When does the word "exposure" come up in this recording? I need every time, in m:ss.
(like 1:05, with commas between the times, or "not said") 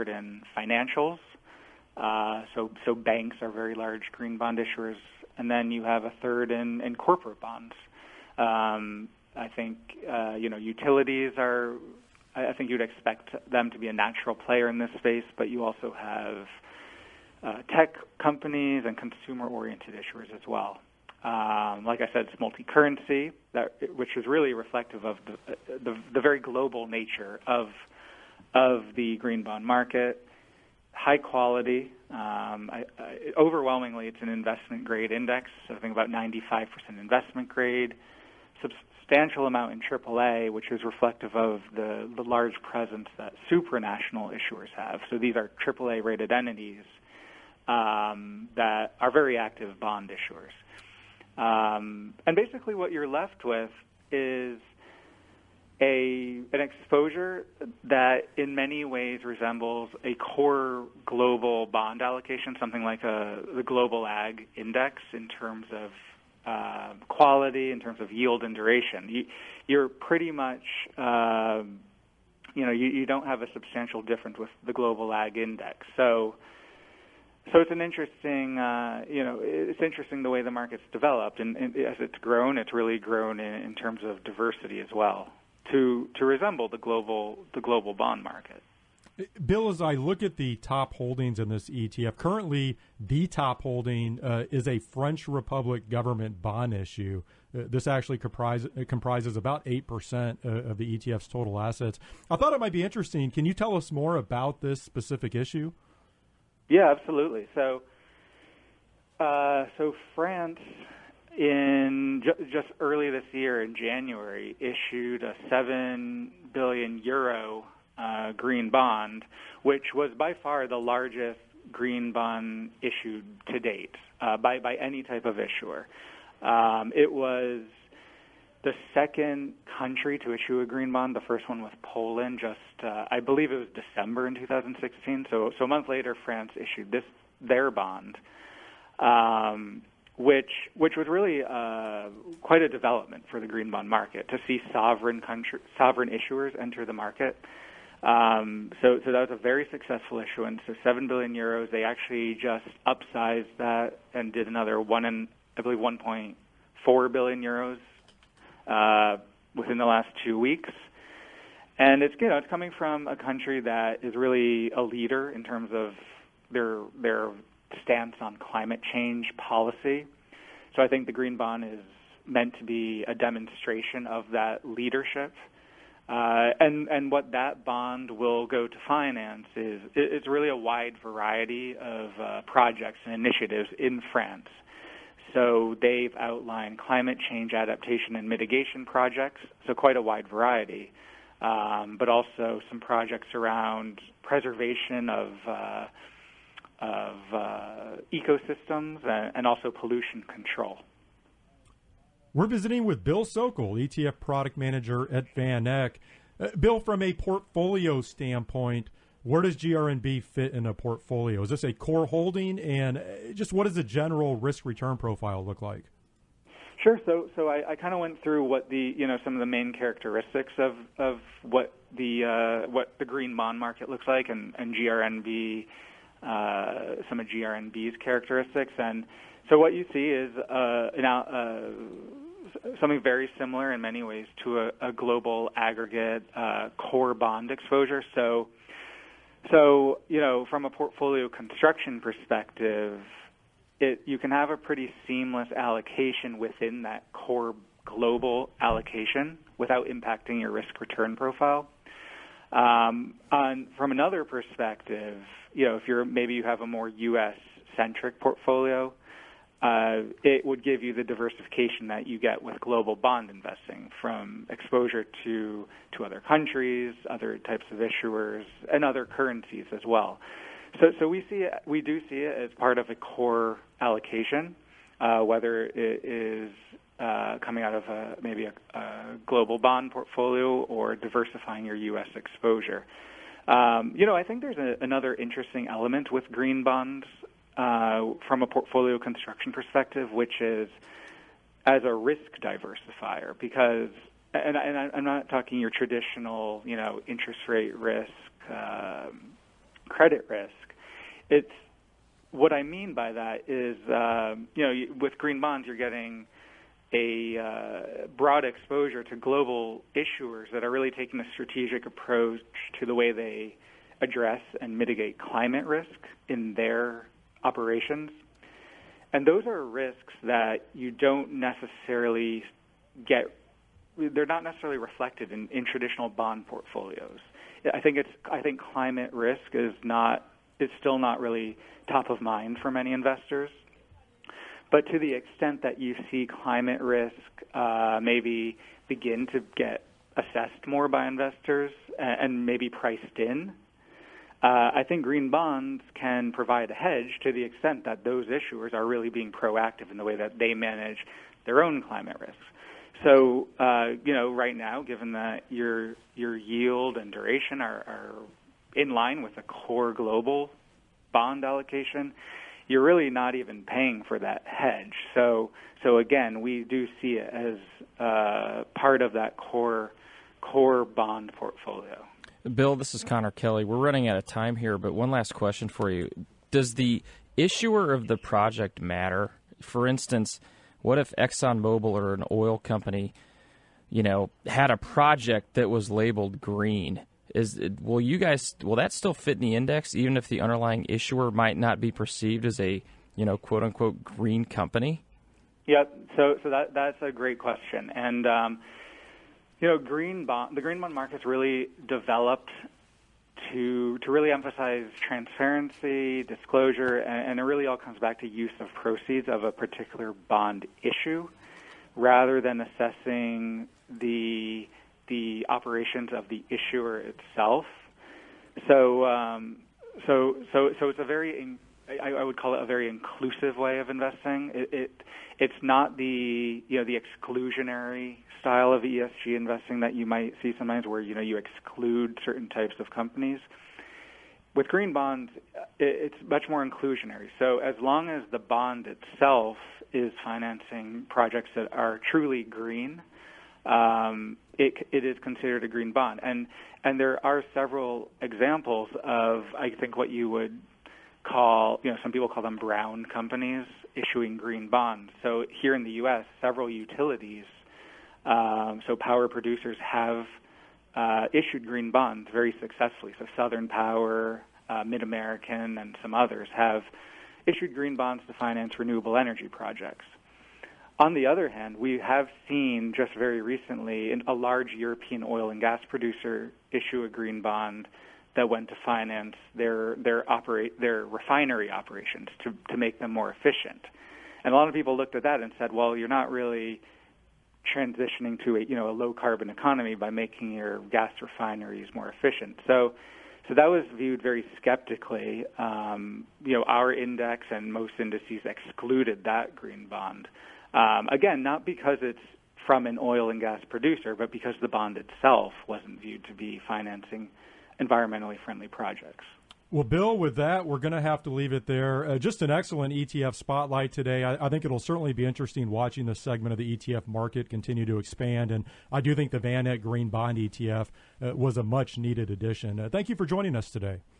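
0:56, 3:57, 4:24, 4:42, 5:08.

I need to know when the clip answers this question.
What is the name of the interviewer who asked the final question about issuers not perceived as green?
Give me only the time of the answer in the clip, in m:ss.
6:13.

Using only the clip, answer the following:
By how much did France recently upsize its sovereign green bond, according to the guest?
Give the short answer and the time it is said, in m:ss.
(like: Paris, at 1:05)
1.4 billion euros, at 2:35.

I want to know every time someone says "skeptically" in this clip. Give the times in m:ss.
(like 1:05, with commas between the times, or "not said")
8:14.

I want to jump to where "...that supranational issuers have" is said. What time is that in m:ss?
0:43.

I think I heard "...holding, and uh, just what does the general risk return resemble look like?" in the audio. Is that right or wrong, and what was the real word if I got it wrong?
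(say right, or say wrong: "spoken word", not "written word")
wrong: "profile", not "resemble".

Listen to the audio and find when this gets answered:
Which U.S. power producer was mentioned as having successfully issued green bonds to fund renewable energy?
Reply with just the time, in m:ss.
7:43.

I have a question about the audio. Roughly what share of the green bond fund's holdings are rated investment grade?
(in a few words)
95%.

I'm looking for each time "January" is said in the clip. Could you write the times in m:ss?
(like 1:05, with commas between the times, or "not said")
1:53.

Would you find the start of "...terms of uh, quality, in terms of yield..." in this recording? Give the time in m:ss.
1:05.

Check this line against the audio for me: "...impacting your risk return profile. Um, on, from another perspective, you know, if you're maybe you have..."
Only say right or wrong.
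right.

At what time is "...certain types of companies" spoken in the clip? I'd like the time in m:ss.
7:12.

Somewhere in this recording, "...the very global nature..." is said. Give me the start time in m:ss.
0:26.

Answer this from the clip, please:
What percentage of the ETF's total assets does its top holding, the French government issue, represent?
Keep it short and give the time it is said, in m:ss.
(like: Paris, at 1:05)
8%, at 1:39.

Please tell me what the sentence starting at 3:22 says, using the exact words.
We're visiting with Bill Sokol, ETF product manager at VanEck.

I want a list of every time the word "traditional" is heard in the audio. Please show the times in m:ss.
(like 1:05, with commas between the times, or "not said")
4:55, 5:25.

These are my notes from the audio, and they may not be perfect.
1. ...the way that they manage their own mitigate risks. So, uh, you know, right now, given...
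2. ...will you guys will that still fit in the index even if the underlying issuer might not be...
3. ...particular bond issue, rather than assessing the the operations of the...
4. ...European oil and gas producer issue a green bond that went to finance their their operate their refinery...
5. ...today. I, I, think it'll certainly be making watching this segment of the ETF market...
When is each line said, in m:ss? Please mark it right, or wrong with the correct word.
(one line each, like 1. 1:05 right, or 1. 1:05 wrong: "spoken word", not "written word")
1. 5:49 wrong: "climate", not "mitigate"
2. 6:27 right
3. 6:49 right
4. 7:54 right
5. 8:33 wrong: "interesting", not "making".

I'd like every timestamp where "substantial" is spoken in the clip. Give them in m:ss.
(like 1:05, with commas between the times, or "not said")
0:39, 1:13.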